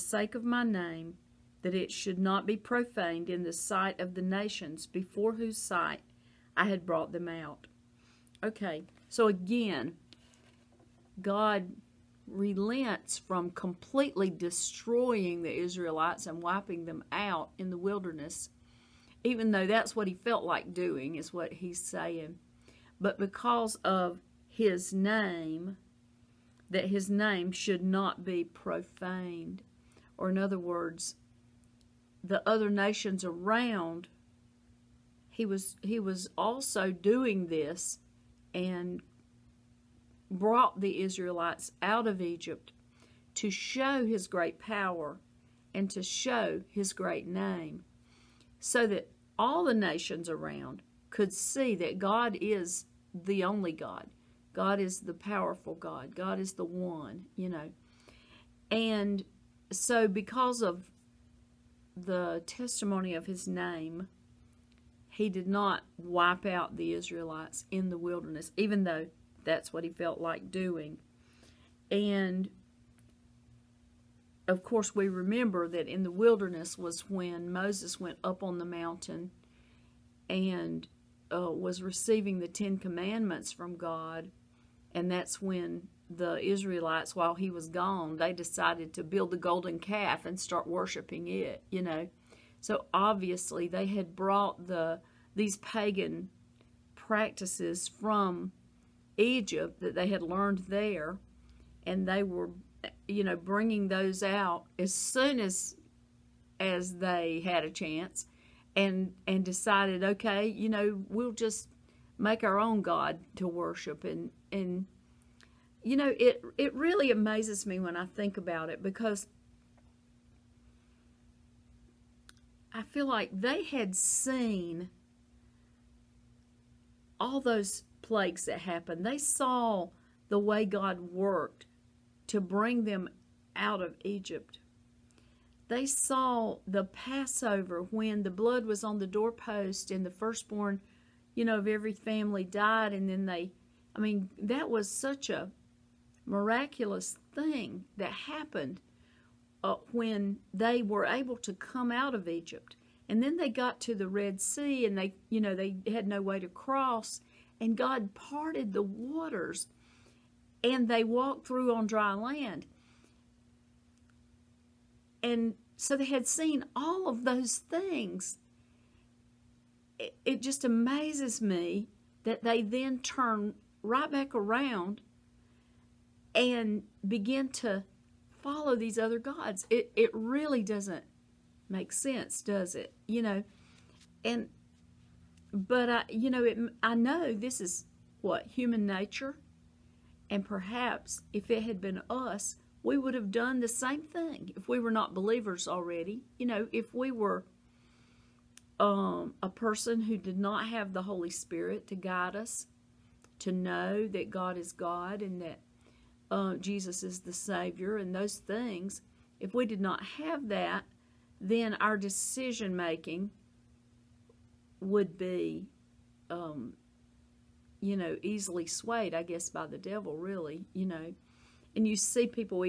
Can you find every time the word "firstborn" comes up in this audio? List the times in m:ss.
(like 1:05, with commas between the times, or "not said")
2:20.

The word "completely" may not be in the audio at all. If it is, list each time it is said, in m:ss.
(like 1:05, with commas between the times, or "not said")
0:13.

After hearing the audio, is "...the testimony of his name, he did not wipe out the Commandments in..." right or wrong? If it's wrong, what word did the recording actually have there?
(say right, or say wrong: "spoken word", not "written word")
wrong: "Israelites", not "Commandments".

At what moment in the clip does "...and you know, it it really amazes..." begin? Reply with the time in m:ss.
1:54.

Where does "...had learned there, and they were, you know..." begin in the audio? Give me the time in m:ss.
1:40.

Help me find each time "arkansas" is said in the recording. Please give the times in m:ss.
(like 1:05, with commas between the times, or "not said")
not said.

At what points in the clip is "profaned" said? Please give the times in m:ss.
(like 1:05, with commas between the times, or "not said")
0:02, 0:28.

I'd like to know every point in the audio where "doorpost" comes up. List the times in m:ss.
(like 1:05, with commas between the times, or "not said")
2:19.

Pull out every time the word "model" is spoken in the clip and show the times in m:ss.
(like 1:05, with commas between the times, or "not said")
not said.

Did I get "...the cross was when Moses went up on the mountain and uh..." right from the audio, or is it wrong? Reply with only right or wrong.
wrong.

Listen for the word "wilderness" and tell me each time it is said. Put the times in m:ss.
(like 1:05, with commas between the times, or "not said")
0:17, 1:07, 1:16.